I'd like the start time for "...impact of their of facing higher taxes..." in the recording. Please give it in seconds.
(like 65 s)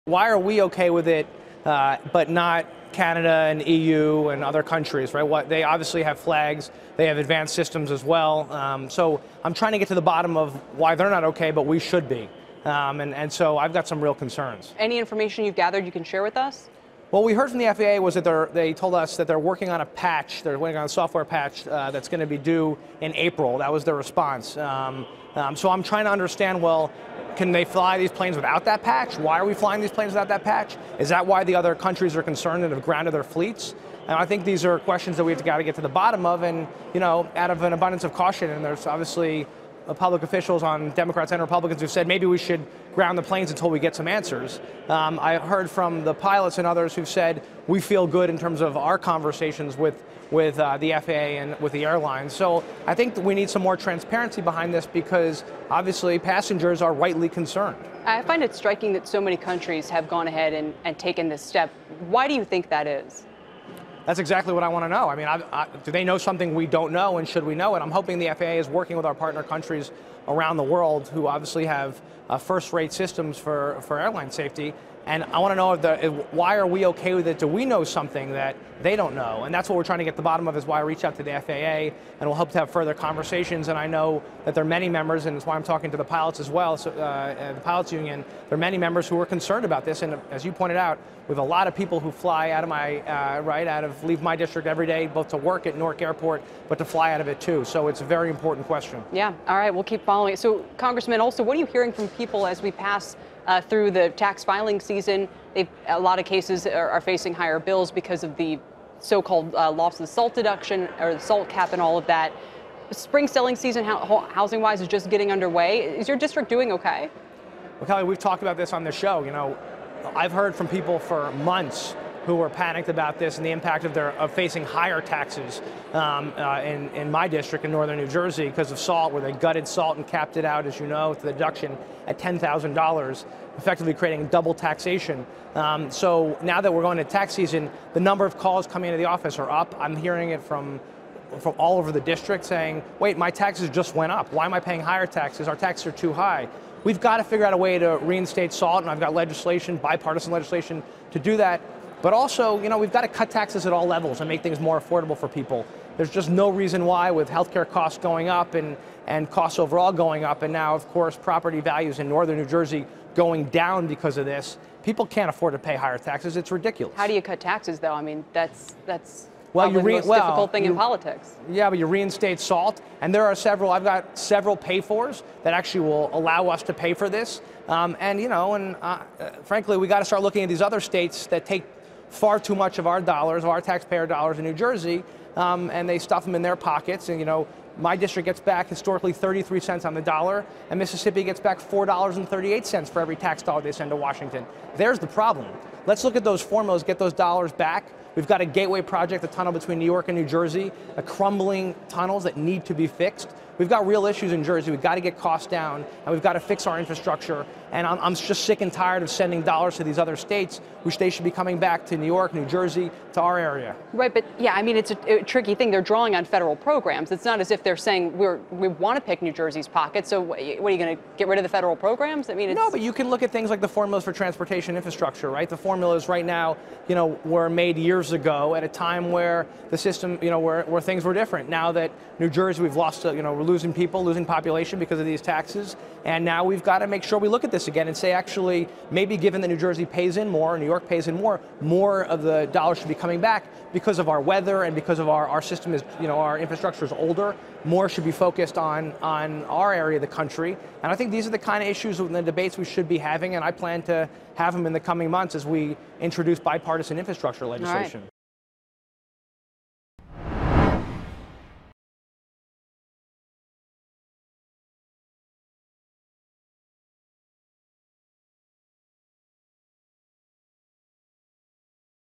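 123 s.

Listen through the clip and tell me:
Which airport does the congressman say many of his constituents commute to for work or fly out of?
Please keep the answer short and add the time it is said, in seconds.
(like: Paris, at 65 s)
Newark Airport, at 95 s.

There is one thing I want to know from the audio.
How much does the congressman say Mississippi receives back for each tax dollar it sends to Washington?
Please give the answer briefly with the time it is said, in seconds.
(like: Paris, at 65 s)
$4.38, at 191 s.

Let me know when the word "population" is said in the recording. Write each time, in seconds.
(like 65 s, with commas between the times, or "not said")
234 s.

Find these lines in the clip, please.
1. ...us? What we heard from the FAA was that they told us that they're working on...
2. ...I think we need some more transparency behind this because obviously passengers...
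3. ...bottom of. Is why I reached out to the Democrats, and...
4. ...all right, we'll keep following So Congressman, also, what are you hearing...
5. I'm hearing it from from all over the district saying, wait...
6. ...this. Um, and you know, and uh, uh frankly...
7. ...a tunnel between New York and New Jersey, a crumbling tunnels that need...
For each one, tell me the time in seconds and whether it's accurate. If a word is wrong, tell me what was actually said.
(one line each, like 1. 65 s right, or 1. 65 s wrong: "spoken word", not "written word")
1. 16 s right
2. 52 s right
3. 80 s wrong: "FAA", not "Democrats"
4. 99 s right
5. 139 s right
6. 177 s right
7. 199 s right.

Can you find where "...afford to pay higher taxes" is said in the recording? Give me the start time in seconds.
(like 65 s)
165 s.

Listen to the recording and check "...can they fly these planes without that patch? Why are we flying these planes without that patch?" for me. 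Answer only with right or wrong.
right.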